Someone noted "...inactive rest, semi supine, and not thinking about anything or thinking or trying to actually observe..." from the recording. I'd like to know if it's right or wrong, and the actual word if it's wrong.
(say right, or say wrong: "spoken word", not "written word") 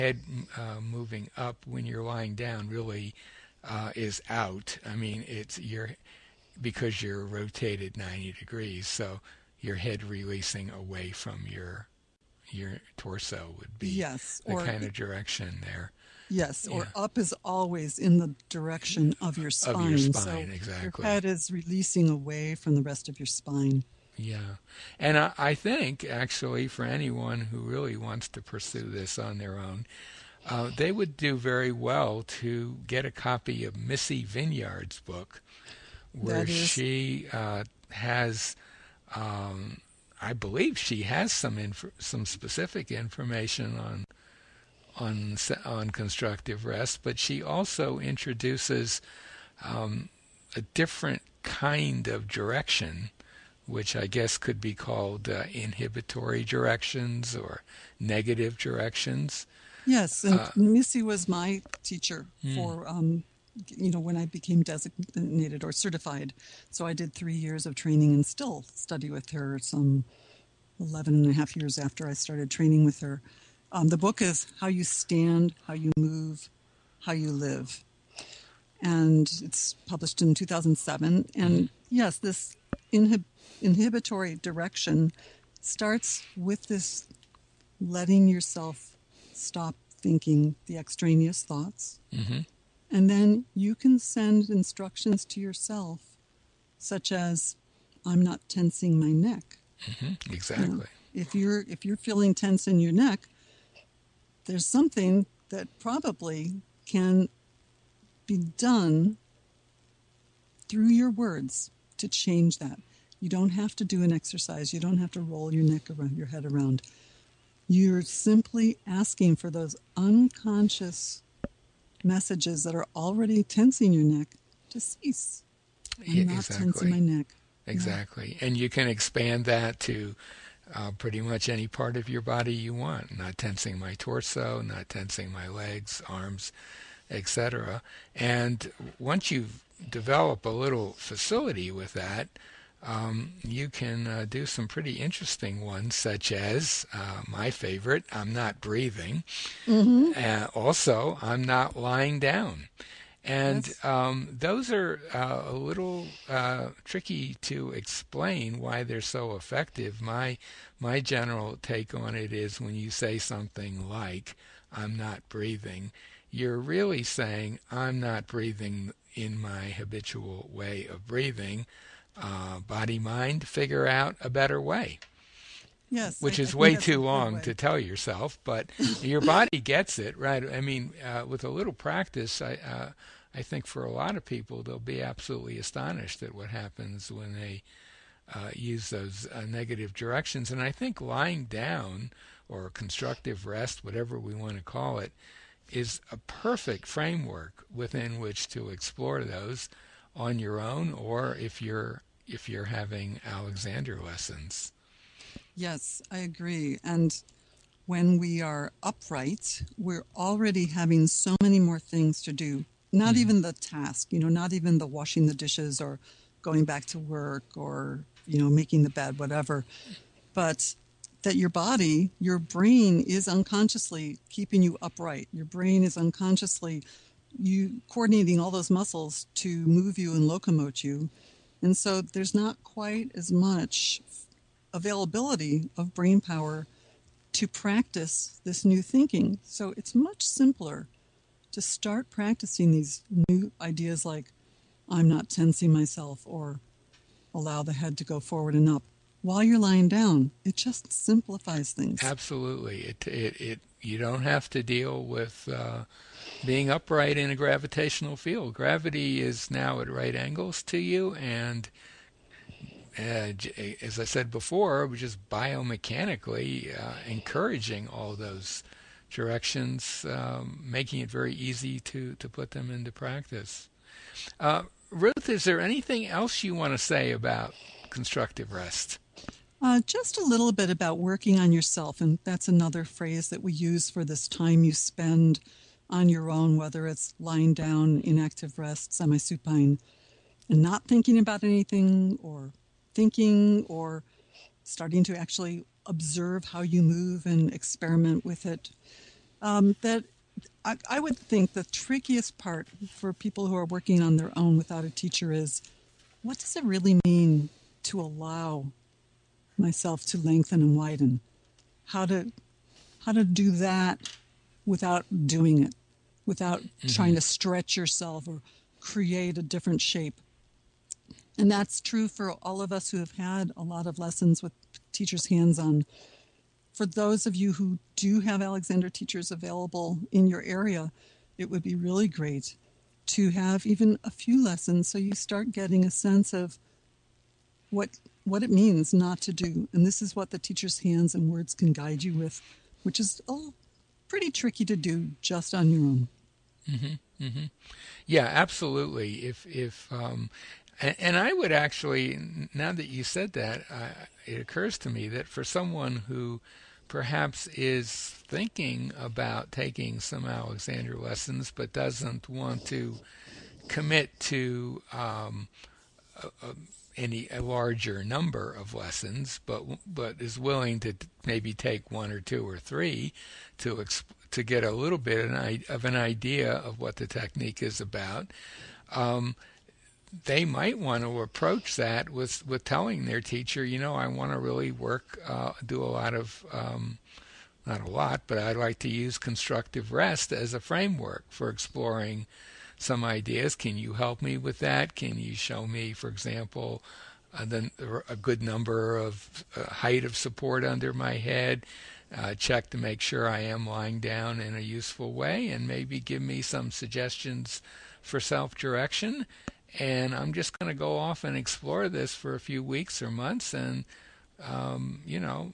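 wrong: "starting", not "trying".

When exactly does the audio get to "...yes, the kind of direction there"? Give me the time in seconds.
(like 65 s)
13 s.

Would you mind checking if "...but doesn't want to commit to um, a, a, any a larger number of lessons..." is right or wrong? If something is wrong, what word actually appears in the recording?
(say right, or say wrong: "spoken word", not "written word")
right.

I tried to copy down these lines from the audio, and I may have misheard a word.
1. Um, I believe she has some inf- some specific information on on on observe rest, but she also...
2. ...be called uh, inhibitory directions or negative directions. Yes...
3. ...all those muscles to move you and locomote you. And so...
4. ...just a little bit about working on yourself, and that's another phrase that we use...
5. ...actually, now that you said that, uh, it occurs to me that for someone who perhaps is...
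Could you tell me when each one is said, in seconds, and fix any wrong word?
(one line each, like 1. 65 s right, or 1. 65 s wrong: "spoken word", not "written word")
1. 39 s wrong: "constructive", not "observe"
2. 54 s right
3. 228 s right
4. 279 s right
5. 351 s right.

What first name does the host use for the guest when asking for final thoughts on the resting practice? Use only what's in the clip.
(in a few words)
Ruth.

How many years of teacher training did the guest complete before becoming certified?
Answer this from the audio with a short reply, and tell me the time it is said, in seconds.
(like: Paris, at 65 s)
3, at 67 s.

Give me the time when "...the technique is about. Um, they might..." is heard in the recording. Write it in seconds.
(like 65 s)
376 s.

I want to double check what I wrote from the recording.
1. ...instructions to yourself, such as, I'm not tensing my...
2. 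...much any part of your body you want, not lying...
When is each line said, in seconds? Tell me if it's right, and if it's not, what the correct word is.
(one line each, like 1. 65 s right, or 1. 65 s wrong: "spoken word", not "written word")
1. 94 s right
2. 131 s wrong: "tensing", not "lying".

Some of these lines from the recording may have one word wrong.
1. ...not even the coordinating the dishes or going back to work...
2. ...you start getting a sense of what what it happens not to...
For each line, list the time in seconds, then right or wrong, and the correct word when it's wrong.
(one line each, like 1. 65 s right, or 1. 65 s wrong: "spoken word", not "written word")
1. 214 s wrong: "washing", not "coordinating"
2. 334 s wrong: "means", not "happens".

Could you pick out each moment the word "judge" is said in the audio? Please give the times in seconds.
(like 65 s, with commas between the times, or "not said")
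not said.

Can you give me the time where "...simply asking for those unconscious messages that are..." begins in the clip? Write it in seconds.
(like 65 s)
118 s.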